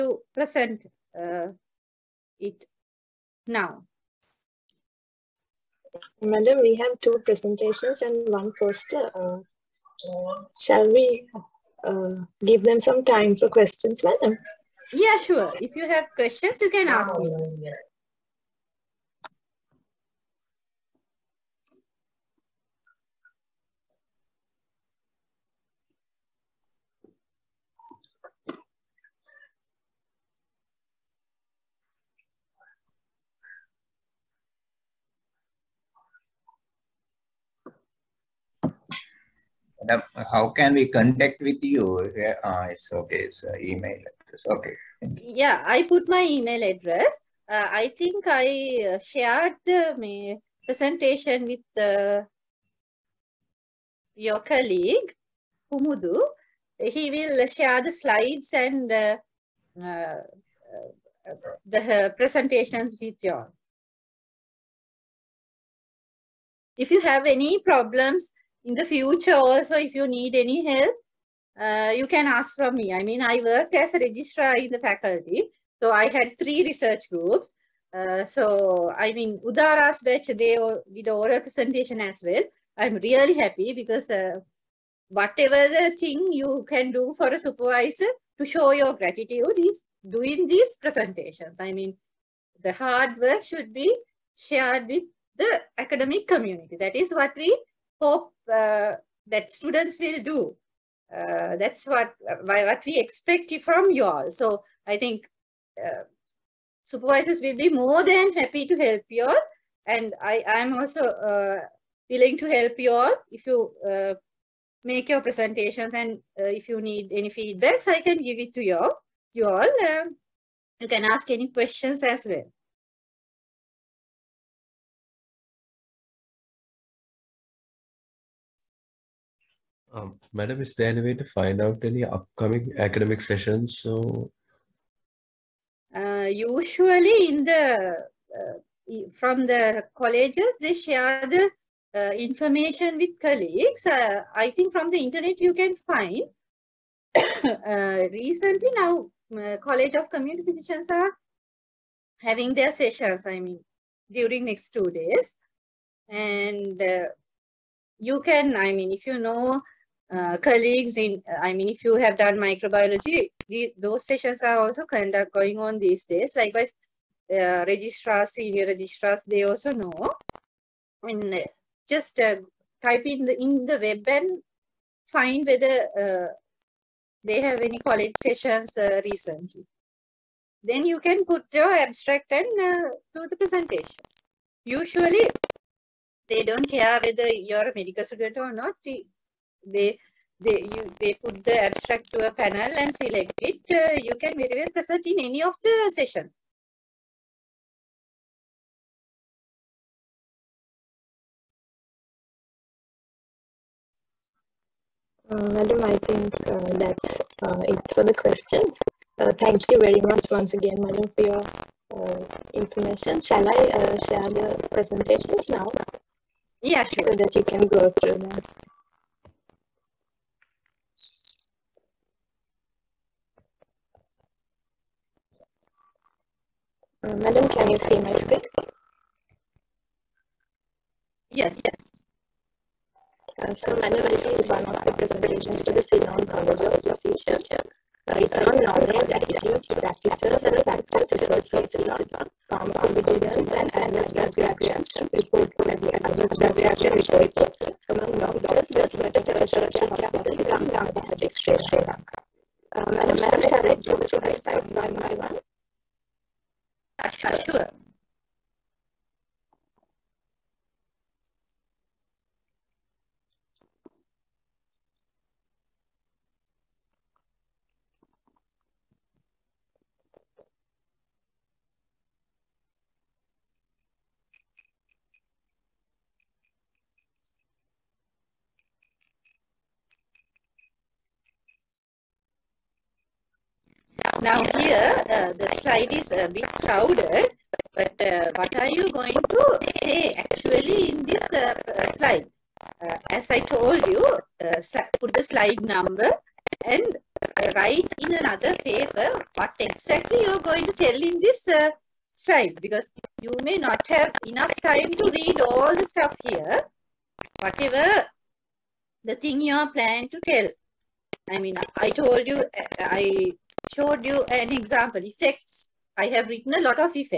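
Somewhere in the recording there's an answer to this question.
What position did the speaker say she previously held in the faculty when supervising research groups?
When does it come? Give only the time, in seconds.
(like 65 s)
73 s.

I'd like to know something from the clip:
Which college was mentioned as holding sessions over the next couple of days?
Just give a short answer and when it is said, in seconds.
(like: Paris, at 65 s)
College of Community Physicians, at 149 s.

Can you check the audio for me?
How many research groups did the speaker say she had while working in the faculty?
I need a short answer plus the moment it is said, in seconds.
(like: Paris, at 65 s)
3, at 76 s.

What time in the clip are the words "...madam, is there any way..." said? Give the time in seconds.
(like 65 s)
130 s.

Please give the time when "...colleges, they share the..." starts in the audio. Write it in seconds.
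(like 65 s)
139 s.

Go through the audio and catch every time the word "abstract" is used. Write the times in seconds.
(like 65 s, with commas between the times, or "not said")
181 s, 191 s.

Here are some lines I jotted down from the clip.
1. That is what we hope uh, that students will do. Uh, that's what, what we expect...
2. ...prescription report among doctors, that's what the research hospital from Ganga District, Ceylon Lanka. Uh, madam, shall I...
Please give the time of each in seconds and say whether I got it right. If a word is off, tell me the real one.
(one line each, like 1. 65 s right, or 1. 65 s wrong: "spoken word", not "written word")
1. 96 s right
2. 246 s wrong: "Sri", not "Ceylon".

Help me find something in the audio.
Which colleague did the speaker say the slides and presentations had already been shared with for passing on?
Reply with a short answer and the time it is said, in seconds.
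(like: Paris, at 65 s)
Kumudu, at 55 s.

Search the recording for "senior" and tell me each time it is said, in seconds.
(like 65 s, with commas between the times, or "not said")
168 s.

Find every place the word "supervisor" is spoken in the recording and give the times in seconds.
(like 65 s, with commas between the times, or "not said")
87 s, 106 s.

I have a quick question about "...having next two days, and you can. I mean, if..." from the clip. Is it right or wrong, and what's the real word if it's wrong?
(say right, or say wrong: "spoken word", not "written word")
wrong: "during", not "having".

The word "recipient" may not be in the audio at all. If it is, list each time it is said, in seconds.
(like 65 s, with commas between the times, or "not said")
not said.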